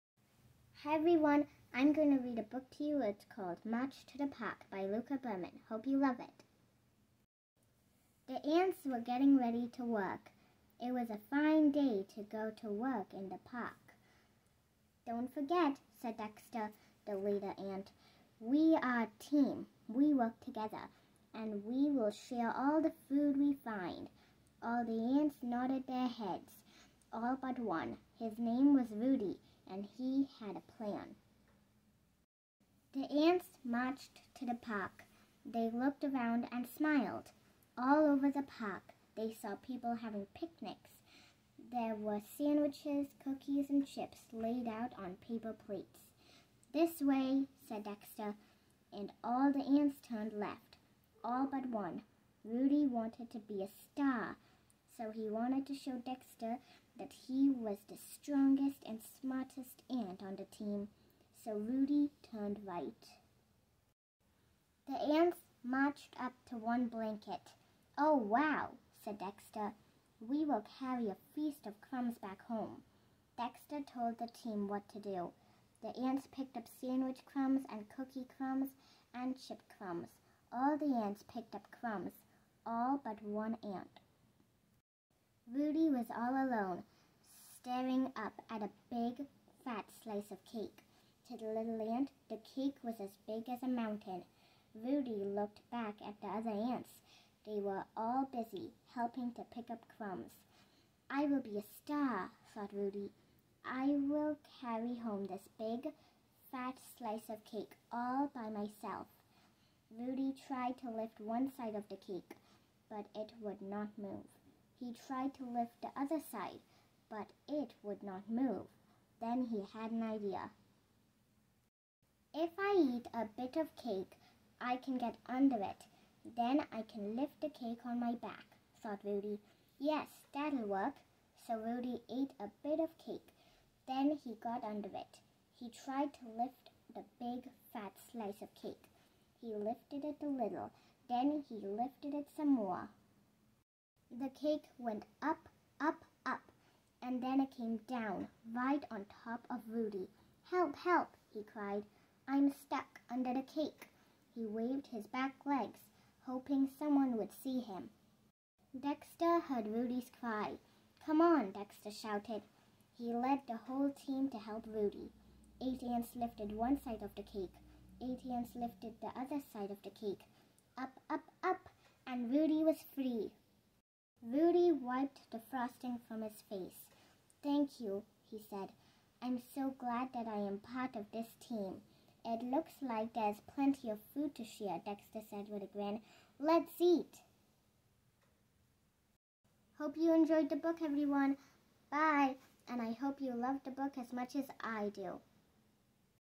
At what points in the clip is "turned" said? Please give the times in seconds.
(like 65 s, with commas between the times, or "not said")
50 s, 62 s.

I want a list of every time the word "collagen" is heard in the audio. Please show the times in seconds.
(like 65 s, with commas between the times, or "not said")
not said.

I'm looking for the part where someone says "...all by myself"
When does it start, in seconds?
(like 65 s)
107 s.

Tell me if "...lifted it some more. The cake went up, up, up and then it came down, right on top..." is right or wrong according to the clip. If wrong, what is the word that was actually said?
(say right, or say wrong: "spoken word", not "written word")
right.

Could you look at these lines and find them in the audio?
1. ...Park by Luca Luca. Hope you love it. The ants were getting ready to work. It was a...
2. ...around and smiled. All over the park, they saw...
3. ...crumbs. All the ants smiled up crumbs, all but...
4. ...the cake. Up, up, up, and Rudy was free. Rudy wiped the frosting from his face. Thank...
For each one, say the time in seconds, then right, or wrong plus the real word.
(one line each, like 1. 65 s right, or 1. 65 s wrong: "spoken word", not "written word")
1. 4 s wrong: "Berman", not "Luca"
2. 36 s right
3. 79 s wrong: "picked", not "smiled"
4. 169 s right.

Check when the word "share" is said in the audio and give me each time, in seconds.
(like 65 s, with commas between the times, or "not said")
22 s, 184 s.